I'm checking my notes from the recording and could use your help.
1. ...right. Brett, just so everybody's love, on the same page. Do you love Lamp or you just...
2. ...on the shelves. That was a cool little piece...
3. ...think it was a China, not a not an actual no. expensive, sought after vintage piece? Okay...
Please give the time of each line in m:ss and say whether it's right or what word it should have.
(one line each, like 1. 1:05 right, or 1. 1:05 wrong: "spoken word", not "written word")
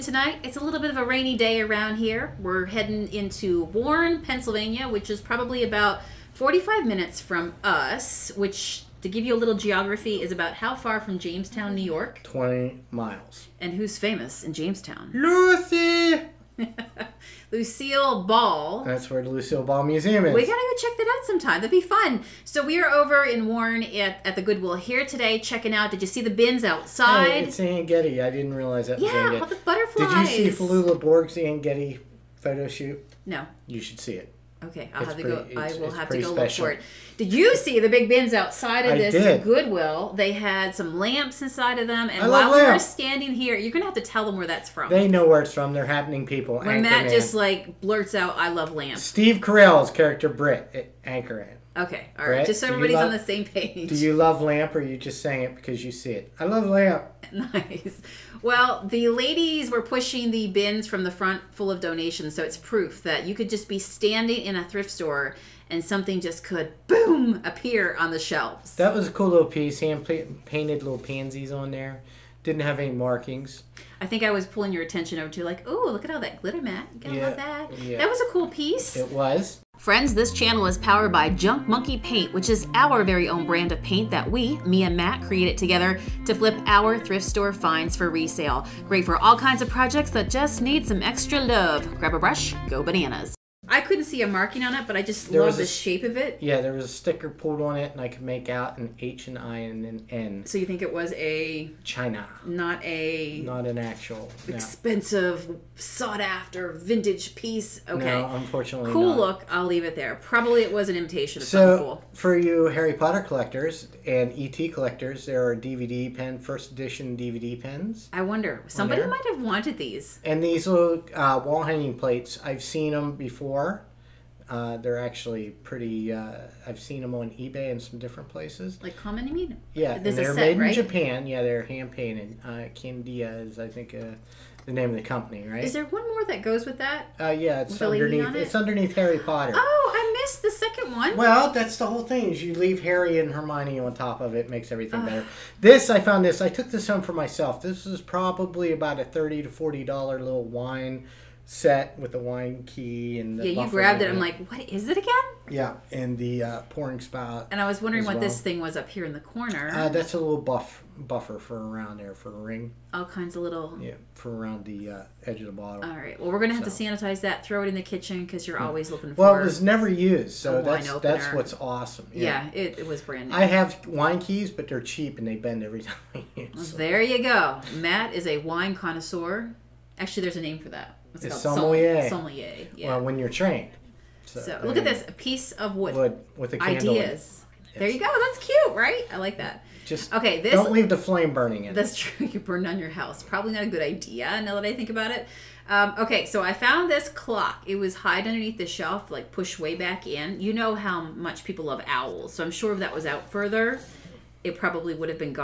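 1. 0:52 right
2. 1:07 right
3. 1:40 right.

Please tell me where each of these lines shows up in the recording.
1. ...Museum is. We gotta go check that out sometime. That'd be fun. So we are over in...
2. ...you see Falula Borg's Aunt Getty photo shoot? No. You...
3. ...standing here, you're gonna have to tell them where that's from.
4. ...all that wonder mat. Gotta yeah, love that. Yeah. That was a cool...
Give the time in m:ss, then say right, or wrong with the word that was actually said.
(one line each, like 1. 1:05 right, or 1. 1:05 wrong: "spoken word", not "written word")
1. 0:19 right
2. 0:30 right
3. 0:42 right
4. 1:16 wrong: "glitter", not "wonder".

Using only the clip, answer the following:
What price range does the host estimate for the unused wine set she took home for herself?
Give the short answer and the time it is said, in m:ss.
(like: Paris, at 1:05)
$30 to $40, at 2:29.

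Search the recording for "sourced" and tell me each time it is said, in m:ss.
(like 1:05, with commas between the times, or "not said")
not said.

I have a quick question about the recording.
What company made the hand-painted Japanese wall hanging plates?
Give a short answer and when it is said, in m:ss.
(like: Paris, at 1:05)
Candia, at 2:12.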